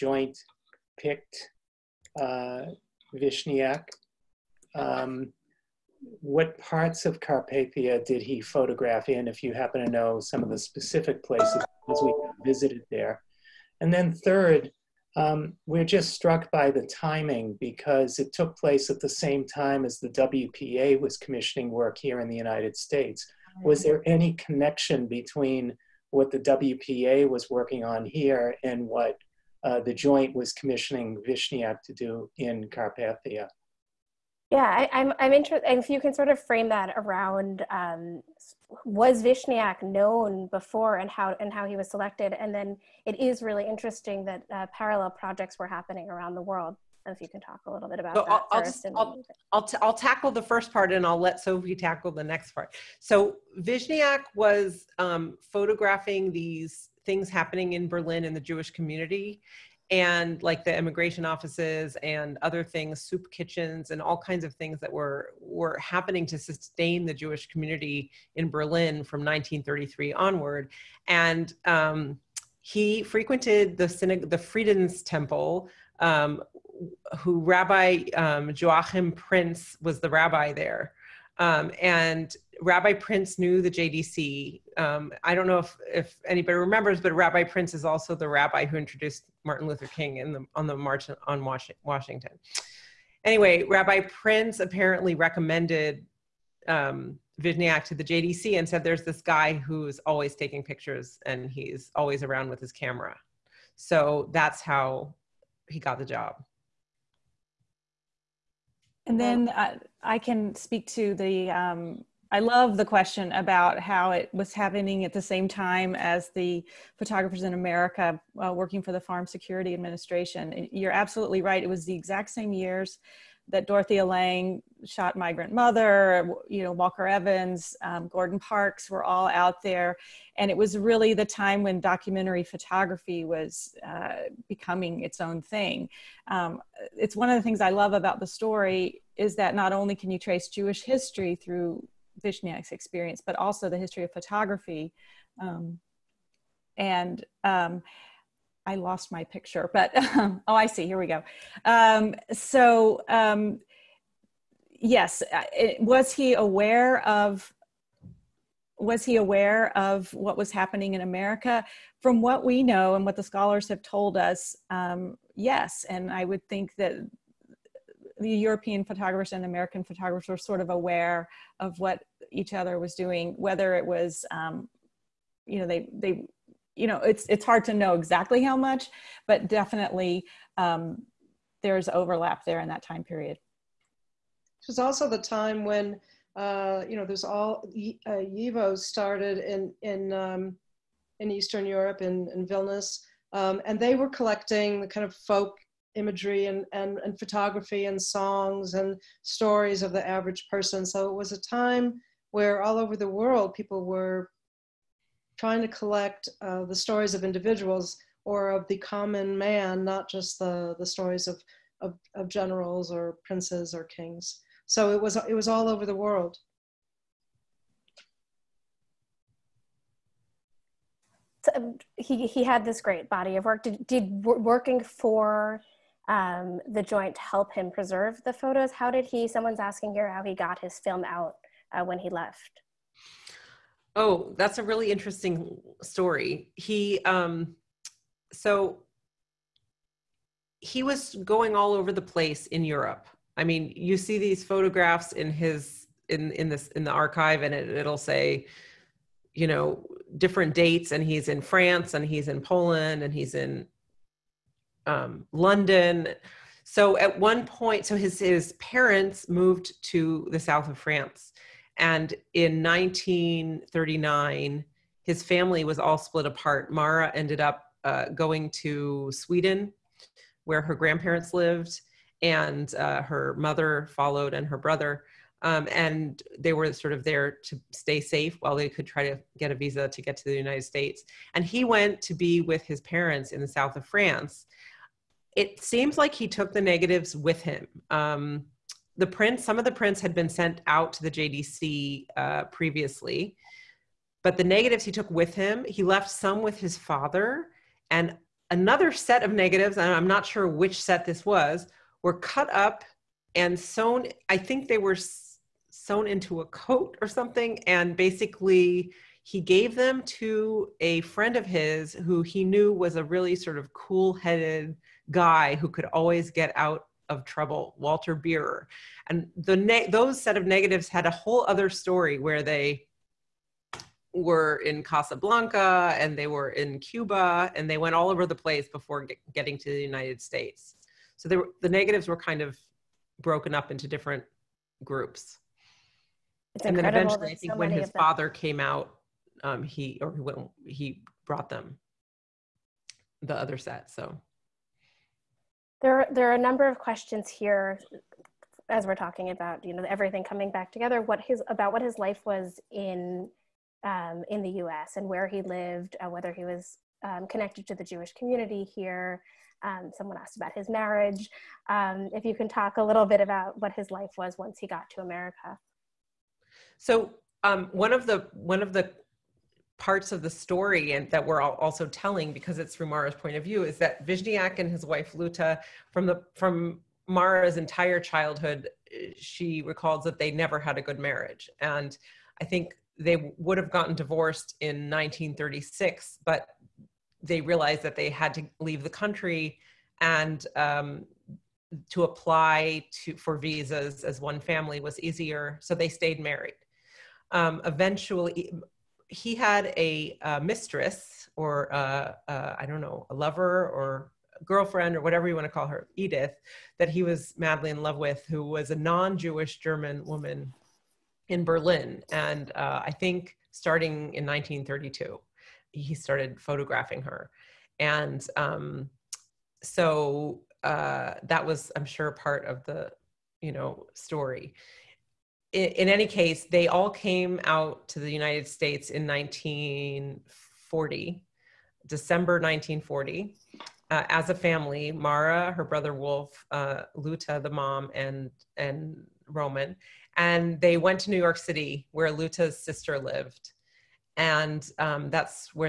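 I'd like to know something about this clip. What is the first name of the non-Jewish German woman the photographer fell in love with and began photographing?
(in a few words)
Edith.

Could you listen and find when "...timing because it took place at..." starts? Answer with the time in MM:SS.
00:16.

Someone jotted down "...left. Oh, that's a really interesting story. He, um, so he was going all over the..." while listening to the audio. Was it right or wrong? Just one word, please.
right.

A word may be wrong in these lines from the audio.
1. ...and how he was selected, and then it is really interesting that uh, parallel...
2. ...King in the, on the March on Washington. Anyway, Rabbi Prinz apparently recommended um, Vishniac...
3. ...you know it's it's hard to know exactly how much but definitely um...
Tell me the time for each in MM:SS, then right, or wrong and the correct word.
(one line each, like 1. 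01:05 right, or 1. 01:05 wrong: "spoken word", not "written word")
1. 00:41 right
2. 01:29 right
3. 02:56 right.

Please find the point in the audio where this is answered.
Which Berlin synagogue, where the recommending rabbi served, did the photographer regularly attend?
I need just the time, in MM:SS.
01:14.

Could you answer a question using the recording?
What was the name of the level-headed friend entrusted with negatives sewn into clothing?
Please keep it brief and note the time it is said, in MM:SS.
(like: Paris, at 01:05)
Walter Beerer, at 05:17.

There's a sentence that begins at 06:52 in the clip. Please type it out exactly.
And uh, I think starting in 1932, he started photographing her.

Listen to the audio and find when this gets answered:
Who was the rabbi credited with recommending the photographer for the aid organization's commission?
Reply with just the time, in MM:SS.
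01:18.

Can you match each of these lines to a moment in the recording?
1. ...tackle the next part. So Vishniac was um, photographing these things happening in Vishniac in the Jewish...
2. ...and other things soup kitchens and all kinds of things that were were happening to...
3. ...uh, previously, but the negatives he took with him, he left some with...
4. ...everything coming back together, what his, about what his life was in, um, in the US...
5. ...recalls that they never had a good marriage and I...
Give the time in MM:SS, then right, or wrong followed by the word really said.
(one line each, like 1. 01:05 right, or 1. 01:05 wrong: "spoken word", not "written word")
1. 00:51 wrong: "Berlin", not "Vishniac"
2. 01:02 right
3. 04:52 right
4. 05:49 right
5. 06:19 right.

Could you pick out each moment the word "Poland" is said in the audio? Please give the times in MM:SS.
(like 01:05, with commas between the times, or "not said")
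04:12.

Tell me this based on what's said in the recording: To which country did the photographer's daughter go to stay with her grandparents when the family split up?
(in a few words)
Sweden.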